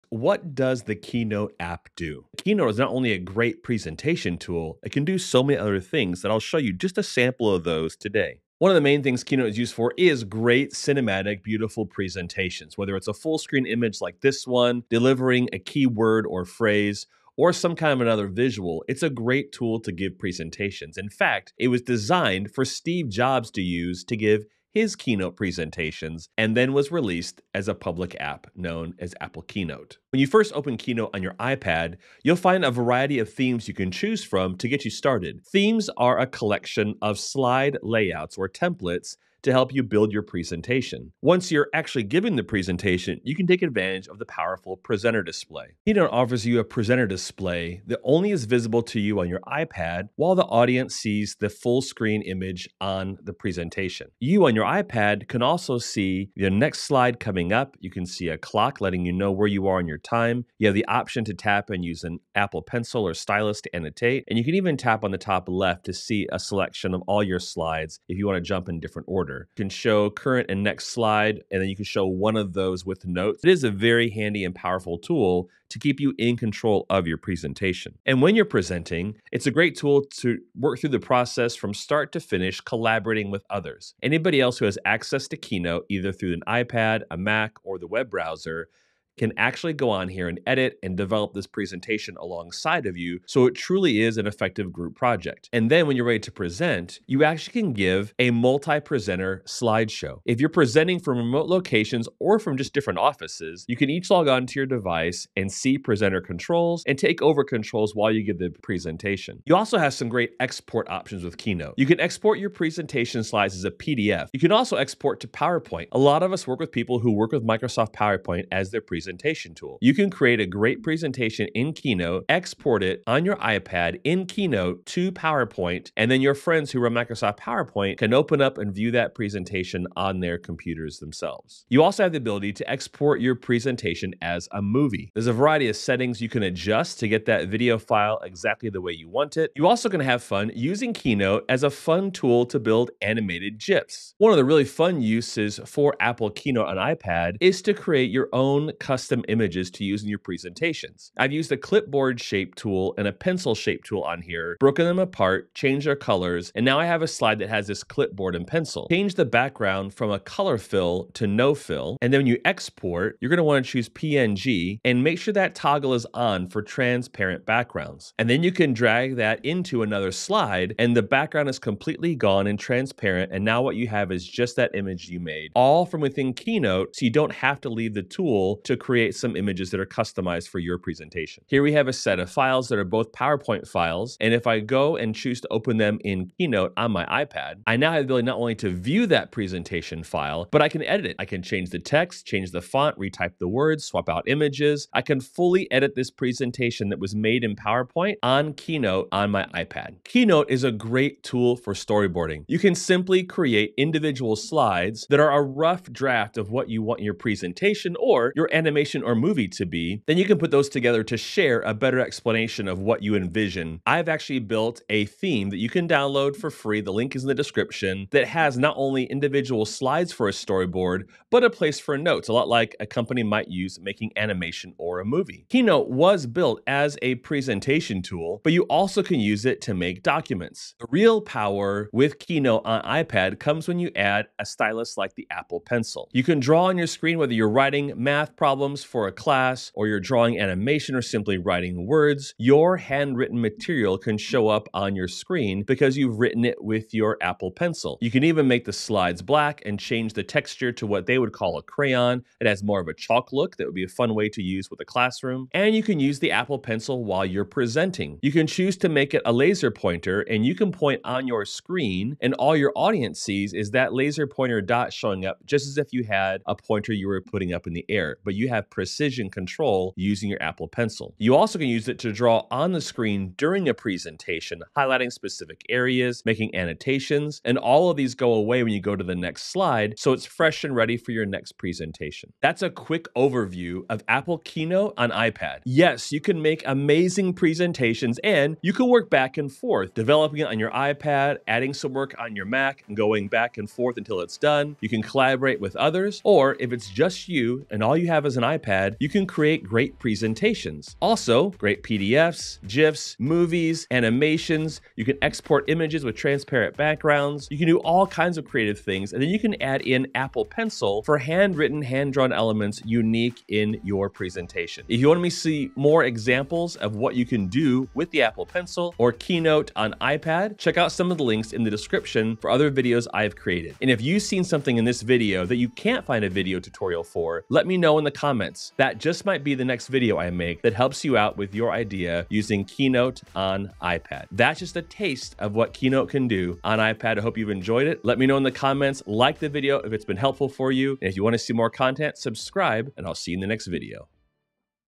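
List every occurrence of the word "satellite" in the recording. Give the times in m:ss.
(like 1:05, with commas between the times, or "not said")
not said.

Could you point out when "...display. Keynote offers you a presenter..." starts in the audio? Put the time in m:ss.
0:45.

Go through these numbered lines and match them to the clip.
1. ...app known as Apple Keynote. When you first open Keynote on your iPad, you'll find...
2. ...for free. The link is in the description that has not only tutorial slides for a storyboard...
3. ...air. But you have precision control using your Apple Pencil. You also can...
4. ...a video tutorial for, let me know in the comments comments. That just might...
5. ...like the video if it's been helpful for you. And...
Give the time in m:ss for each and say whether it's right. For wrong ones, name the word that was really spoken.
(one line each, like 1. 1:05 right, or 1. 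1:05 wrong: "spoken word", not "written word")
1. 0:28 right
2. 3:36 wrong: "individual", not "tutorial"
3. 4:27 right
4. 5:26 right
5. 5:39 right.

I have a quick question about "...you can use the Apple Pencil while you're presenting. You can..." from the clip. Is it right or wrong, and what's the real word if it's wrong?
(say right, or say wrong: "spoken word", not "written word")
right.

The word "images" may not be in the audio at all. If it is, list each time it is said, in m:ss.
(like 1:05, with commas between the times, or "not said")
0:13, 0:52, 2:29, 2:54, 2:59, 3:14, 5:05.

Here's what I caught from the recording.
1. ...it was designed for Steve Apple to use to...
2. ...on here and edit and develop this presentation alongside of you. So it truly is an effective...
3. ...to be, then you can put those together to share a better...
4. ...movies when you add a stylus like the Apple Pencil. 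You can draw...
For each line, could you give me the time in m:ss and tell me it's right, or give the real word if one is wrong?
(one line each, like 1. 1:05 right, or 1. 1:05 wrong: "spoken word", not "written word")
1. 0:21 wrong: "Jobs", not "Apple"
2. 1:29 right
3. 3:29 right
4. 3:53 wrong: "comes", not "movies".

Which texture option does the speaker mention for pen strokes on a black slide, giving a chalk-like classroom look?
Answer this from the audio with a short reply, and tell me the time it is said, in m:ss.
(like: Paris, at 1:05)
crayon, at 4:11.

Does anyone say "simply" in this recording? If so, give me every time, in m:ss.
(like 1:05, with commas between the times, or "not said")
3:22, 4:01.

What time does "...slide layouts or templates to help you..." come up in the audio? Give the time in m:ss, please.
0:37.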